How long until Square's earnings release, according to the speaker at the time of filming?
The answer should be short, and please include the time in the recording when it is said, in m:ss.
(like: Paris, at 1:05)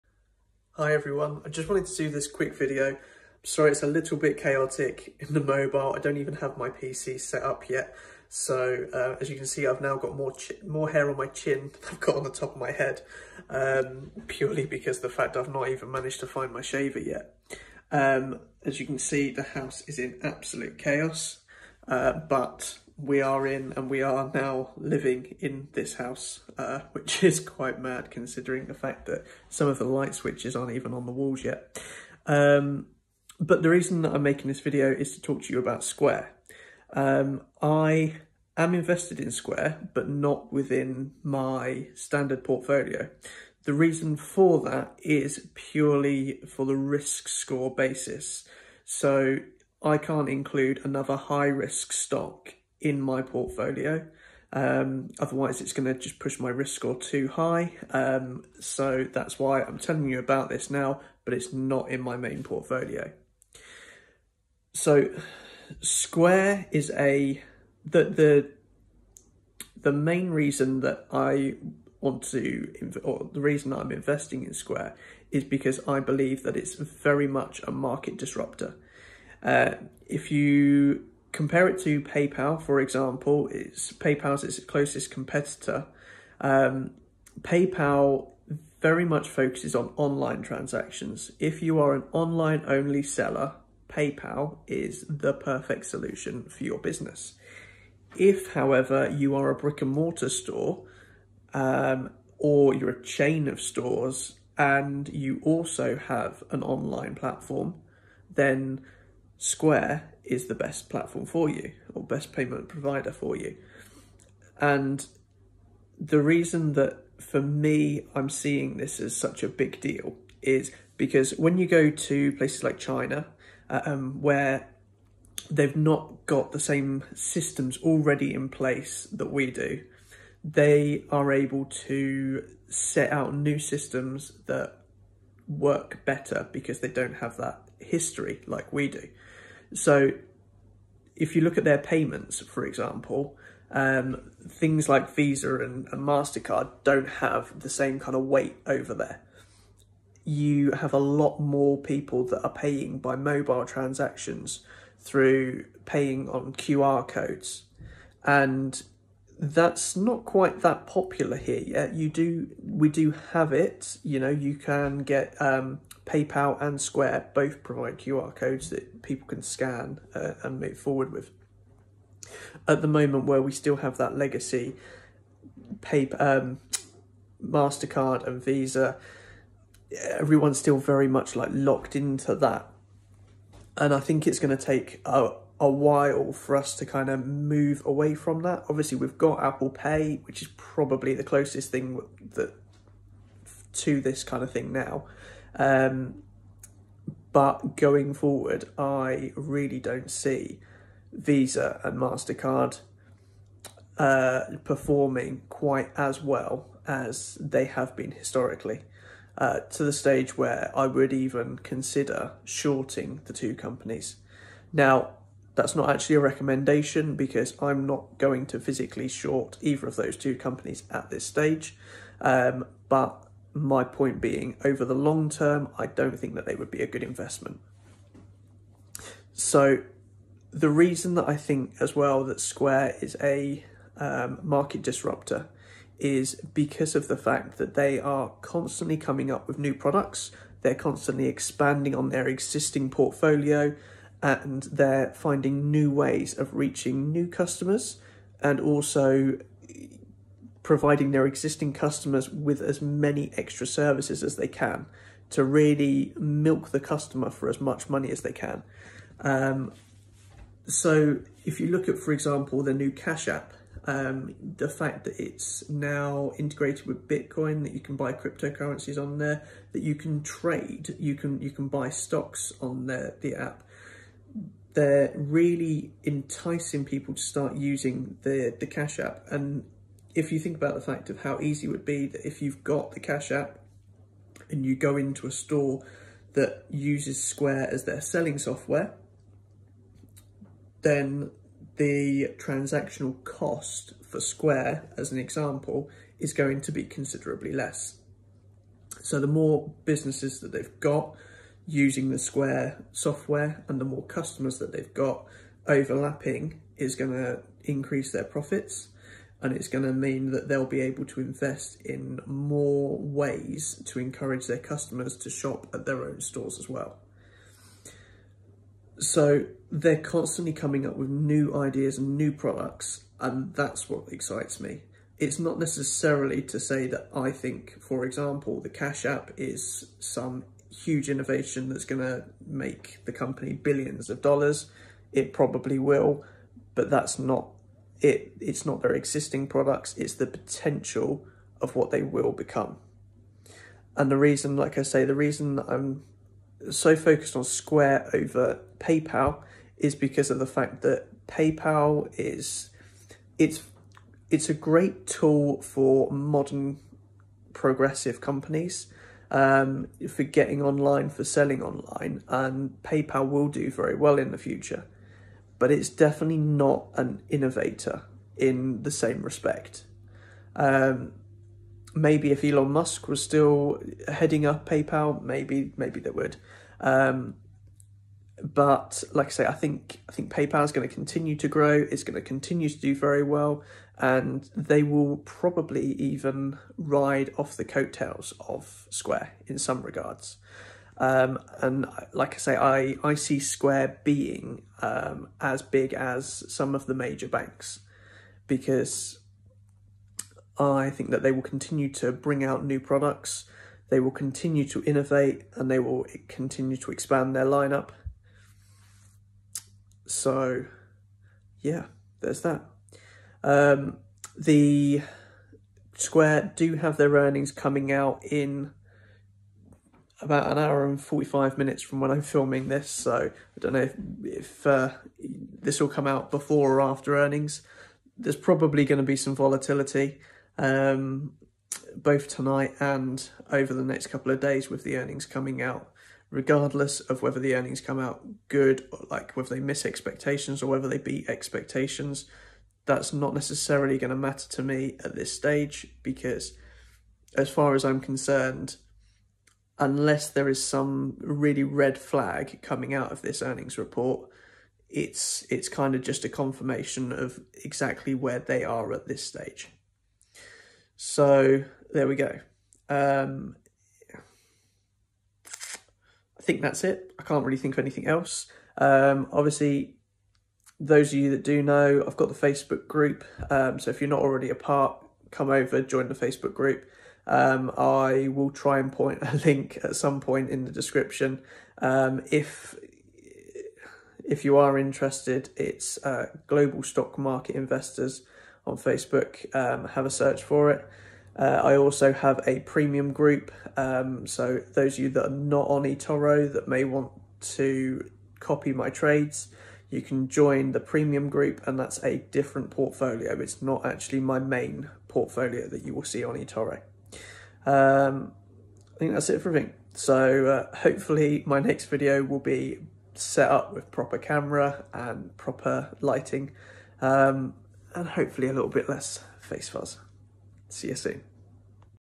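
1 hour 45 minutes, at 7:00.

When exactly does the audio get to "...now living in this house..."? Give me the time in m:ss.
0:24.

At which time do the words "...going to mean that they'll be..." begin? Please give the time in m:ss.
5:09.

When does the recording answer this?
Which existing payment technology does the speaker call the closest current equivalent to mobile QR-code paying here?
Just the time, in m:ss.
3:09.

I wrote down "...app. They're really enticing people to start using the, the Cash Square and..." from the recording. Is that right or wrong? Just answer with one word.
wrong.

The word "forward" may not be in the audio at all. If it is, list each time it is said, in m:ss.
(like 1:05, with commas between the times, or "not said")
2:50, 3:18.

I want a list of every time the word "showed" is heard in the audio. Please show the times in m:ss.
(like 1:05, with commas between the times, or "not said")
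not said.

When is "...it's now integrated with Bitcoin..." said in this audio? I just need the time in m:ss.
4:25.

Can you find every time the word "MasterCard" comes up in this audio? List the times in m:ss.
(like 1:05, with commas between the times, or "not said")
2:26, 2:57, 3:21.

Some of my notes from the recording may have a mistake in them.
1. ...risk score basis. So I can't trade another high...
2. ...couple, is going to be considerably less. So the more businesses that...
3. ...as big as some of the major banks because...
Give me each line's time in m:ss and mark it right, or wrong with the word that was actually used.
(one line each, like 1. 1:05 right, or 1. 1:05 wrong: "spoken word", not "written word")
1. 0:46 wrong: "include", not "trade"
2. 4:55 wrong: "example", not "couple"
3. 6:35 right.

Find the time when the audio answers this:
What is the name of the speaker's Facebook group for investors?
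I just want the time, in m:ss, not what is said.
8:06.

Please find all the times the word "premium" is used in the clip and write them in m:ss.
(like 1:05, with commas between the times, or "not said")
8:12, 8:20.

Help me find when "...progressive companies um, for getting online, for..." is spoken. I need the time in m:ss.
5:57.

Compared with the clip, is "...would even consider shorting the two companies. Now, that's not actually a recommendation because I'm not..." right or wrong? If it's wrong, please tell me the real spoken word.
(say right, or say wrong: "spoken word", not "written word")
right.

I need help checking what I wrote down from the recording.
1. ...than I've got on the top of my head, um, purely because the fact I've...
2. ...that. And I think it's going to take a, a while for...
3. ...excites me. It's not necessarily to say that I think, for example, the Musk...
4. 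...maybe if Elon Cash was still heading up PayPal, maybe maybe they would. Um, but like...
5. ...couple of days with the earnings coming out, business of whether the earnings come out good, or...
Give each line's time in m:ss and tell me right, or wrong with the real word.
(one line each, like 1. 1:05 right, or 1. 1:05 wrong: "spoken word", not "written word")
1. 0:11 right
2. 3:02 right
3. 5:24 wrong: "Cash", not "Musk"
4. 6:11 wrong: "Musk", not "Cash"
5. 7:14 wrong: "regardless", not "business".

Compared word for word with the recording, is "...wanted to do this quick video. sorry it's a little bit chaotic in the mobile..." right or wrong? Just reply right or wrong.
right.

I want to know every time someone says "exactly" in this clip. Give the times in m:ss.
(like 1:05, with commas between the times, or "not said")
7:37.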